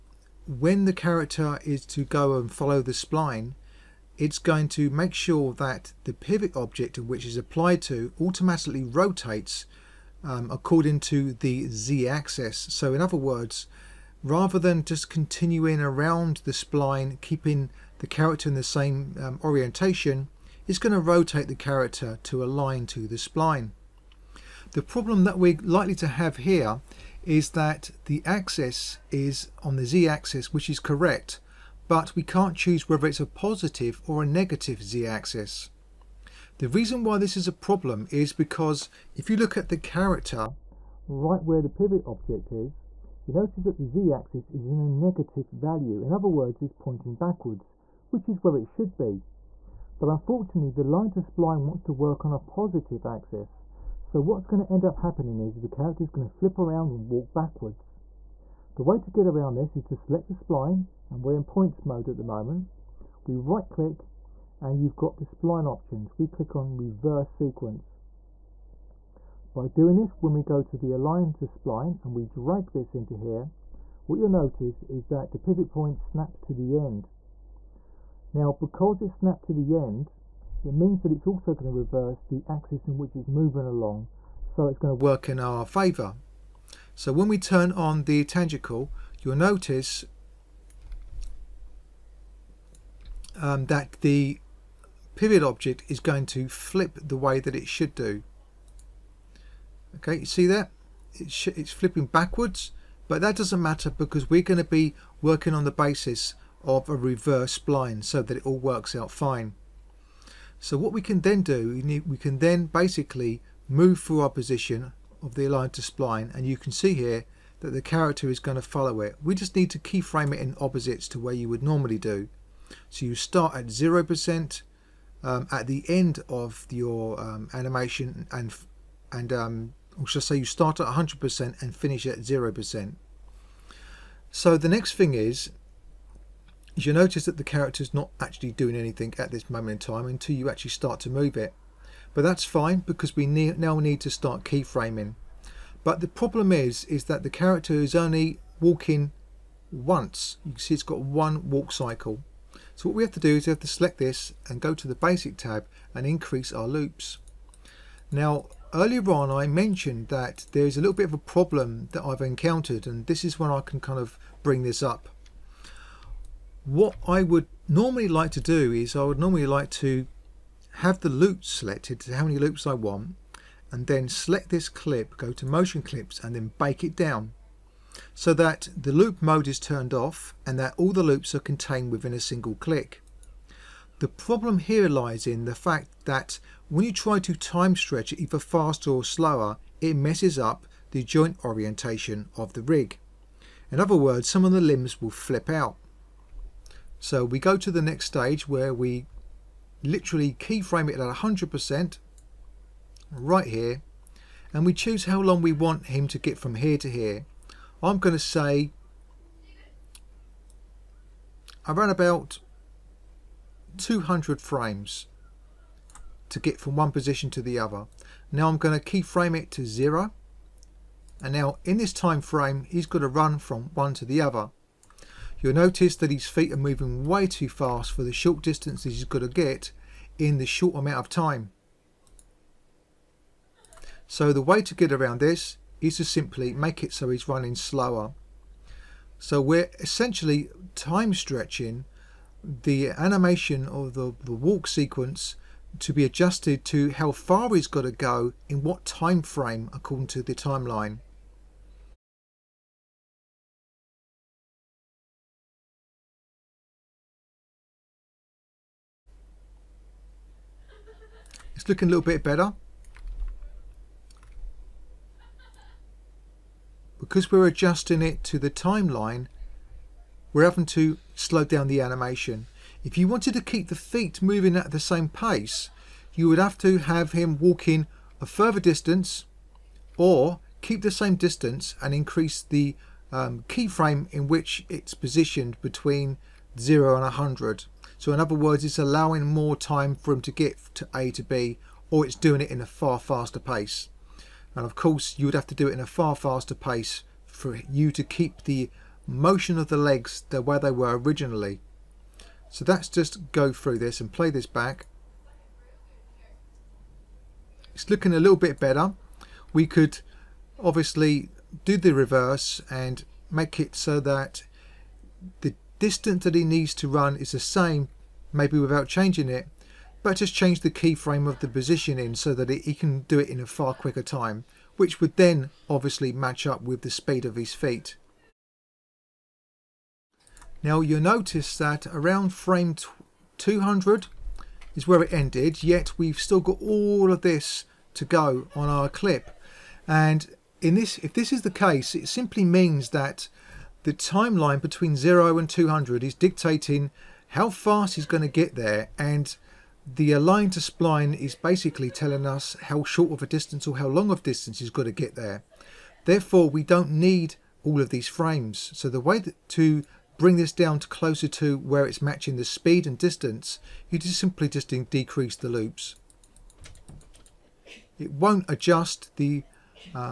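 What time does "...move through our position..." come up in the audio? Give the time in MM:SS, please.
01:53.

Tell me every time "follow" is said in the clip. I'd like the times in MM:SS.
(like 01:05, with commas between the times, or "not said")
00:02, 01:58.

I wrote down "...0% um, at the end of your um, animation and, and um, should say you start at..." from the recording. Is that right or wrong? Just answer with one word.
right.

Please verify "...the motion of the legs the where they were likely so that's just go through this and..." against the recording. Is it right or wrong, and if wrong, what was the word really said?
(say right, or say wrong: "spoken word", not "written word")
wrong: "originally", not "likely".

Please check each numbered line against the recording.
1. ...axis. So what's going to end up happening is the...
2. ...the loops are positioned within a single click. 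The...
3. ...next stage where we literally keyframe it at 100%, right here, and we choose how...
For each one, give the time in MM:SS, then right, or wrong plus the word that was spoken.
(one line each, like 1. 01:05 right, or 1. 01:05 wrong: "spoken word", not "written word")
1. 00:53 right
2. 03:00 wrong: "contained", not "positioned"
3. 03:17 right.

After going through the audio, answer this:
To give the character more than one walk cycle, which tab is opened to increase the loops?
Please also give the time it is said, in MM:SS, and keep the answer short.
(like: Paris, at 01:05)
Basic tab, at 02:34.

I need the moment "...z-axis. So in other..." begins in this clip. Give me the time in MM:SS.
00:11.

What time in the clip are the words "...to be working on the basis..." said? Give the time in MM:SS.
01:44.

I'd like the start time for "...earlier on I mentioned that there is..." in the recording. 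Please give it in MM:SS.
02:38.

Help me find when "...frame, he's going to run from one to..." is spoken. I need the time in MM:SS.
03:42.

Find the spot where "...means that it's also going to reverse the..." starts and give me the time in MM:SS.
01:20.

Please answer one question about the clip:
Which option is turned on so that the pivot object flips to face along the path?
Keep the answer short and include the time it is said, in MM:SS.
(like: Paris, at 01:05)
Tangential, at 01:28.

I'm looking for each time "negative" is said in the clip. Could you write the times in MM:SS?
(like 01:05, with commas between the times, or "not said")
00:34, 00:44.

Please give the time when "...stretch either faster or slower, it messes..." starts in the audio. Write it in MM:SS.
03:07.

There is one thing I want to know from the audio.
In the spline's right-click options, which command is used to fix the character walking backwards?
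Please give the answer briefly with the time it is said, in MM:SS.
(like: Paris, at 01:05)
Reverse sequence, at 01:06.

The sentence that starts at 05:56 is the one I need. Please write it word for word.
Therefore, we don't need all of these frames.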